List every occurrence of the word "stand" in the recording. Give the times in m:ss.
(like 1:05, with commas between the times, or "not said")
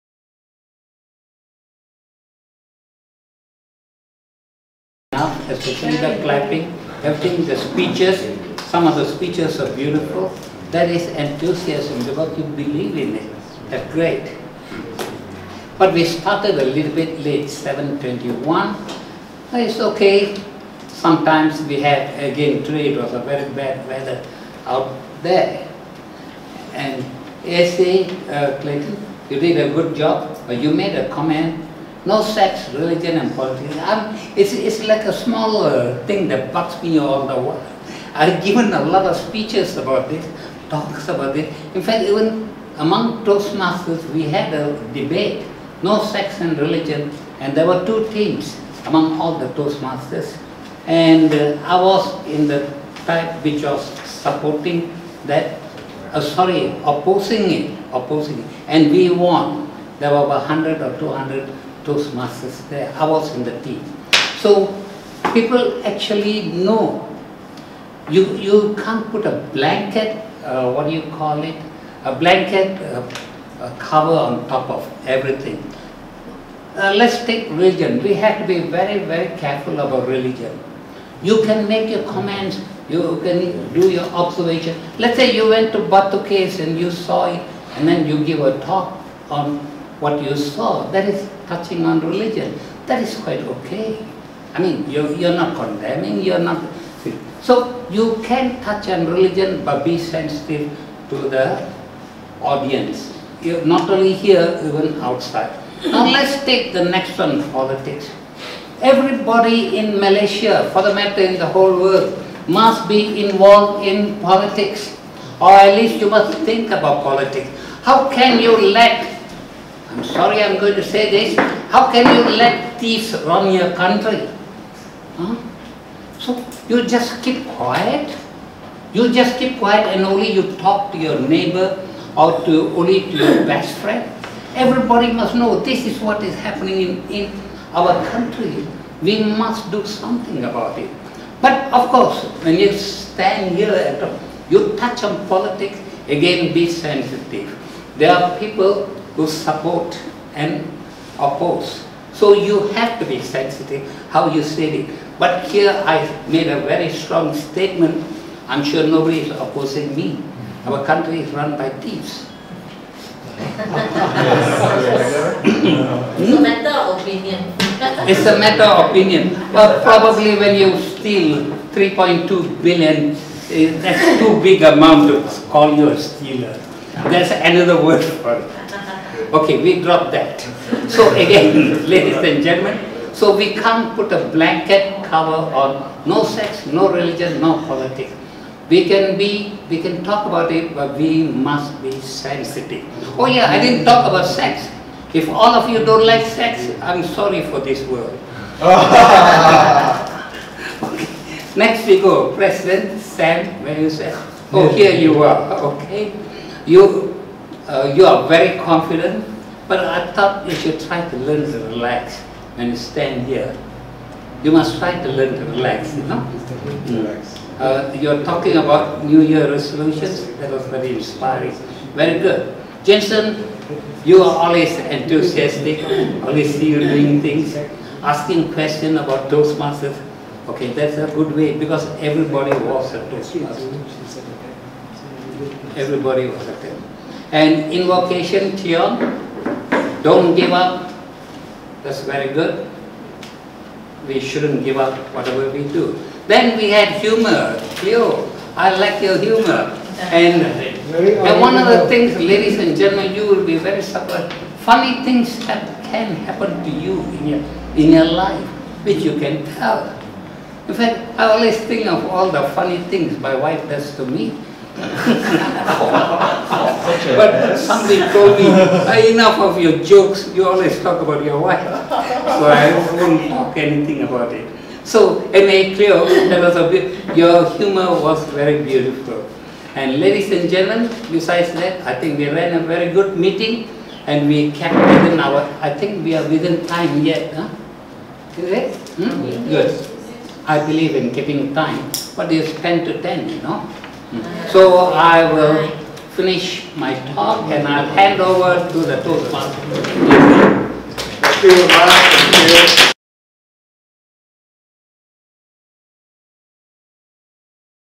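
2:22, 3:32.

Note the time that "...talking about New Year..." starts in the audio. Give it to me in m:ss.
3:38.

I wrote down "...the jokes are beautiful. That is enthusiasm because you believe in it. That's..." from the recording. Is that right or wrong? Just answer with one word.
wrong.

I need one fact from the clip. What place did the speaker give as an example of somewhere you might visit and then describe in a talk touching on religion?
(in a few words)
Batu Caves.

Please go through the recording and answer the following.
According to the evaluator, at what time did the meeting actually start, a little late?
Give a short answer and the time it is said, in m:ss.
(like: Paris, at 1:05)
7.21, at 0:17.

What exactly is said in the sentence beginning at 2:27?
There are people who support and oppose.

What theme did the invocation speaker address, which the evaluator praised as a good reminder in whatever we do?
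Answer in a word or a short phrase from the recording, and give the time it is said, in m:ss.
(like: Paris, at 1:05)
Don't give up, at 4:00.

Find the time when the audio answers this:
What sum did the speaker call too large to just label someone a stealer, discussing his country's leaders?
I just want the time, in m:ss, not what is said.
2:51.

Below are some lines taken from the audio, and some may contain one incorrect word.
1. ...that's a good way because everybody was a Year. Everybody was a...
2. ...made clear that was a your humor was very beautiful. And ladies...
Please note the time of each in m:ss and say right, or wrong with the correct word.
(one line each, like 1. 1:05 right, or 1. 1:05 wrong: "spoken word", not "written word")
1. 3:50 wrong: "Toastmaster", not "Year"
2. 4:35 right.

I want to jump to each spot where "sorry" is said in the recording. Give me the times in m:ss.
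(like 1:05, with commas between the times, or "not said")
0:56, 2:00, 3:17.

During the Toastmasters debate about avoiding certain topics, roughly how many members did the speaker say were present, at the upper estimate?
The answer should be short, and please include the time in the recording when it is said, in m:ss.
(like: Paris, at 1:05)
200, at 1:00.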